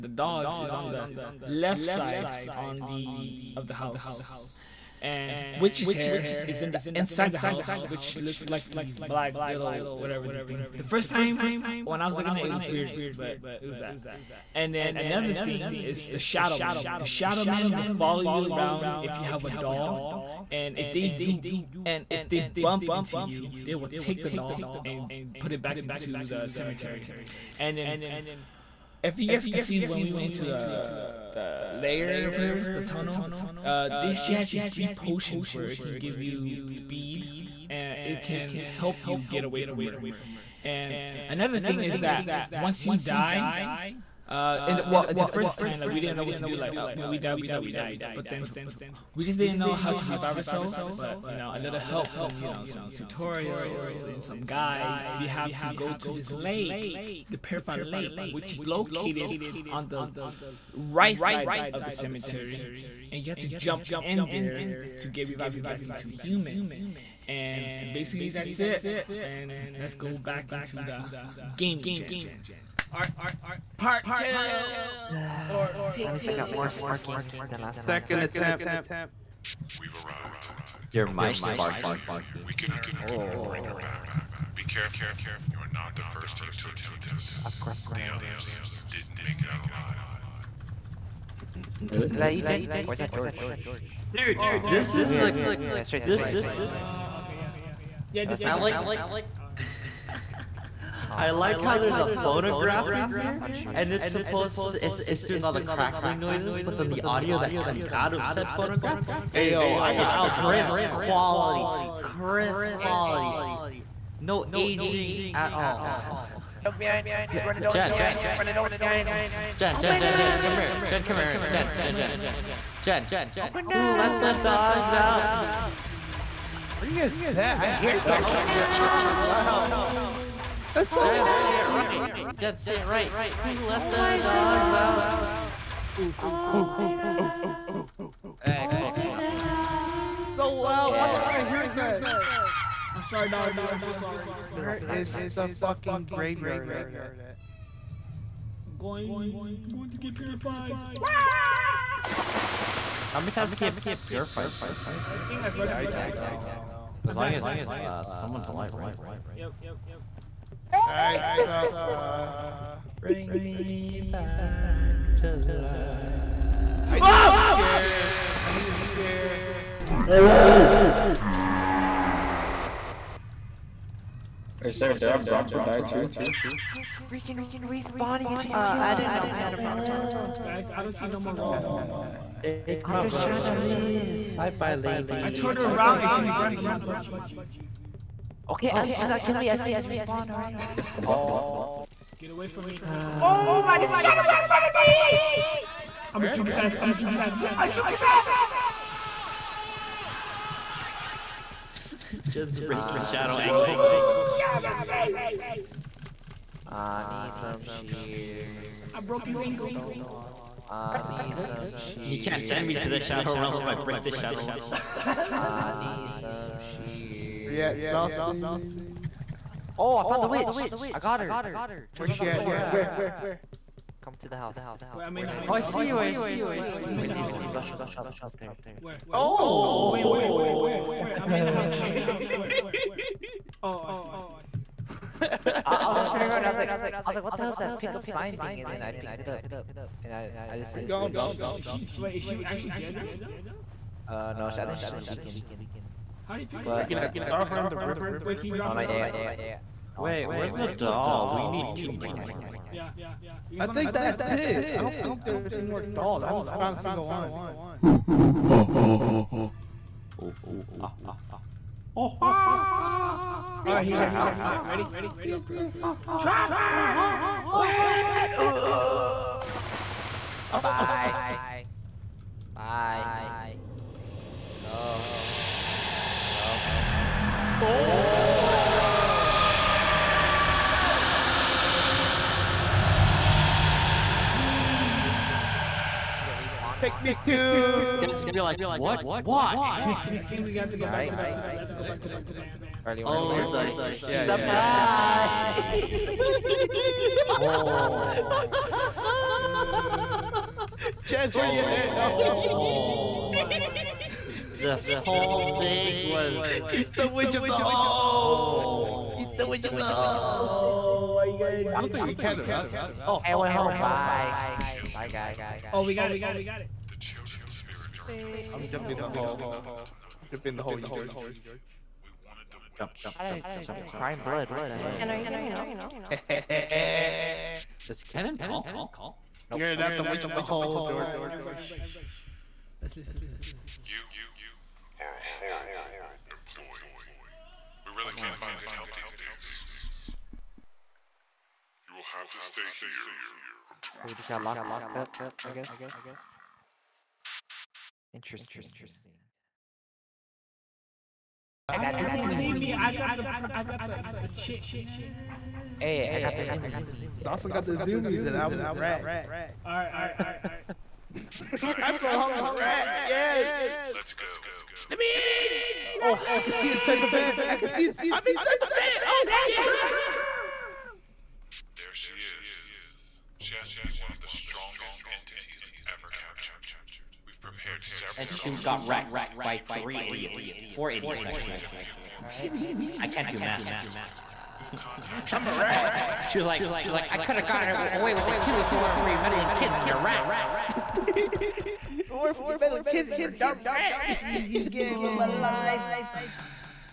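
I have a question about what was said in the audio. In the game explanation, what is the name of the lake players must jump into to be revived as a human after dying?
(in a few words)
Purified Lake.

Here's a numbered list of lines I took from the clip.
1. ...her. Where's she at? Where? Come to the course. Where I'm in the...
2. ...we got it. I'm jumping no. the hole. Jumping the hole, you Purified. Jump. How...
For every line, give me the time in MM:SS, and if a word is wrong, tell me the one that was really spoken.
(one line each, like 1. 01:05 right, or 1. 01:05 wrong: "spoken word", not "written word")
1. 03:41 wrong: "house", not "course"
2. 05:15 wrong: "George", not "Purified".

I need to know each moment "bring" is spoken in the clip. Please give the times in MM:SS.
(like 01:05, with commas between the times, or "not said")
01:23, 02:42.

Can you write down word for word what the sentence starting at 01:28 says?
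others didn't make it out alive.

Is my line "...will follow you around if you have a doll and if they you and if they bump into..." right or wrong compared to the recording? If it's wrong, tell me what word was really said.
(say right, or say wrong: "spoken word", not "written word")
right.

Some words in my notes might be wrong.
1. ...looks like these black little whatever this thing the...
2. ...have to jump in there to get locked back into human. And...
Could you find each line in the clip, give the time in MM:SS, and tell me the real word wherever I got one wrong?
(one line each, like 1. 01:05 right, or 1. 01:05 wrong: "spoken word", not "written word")
1. 00:08 right
2. 01:03 wrong: "revived", not "locked".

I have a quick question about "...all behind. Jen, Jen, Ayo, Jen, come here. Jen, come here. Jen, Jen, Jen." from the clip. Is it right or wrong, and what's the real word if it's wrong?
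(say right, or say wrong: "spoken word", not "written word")
wrong: "Jen", not "Ayo".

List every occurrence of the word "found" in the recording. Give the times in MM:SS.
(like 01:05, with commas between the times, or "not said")
03:40, 04:16.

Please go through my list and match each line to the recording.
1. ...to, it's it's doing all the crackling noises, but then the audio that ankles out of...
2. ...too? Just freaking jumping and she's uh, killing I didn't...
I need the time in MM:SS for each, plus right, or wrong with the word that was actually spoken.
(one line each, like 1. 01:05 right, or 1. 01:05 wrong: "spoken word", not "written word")
1. 01:44 wrong: "comes", not "ankles"
2. 02:55 wrong: "respawning", not "jumping".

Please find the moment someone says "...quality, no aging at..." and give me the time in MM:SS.
01:52.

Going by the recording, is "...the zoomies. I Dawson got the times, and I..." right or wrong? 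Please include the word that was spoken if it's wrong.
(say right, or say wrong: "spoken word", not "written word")
wrong: "zoomies", not "times".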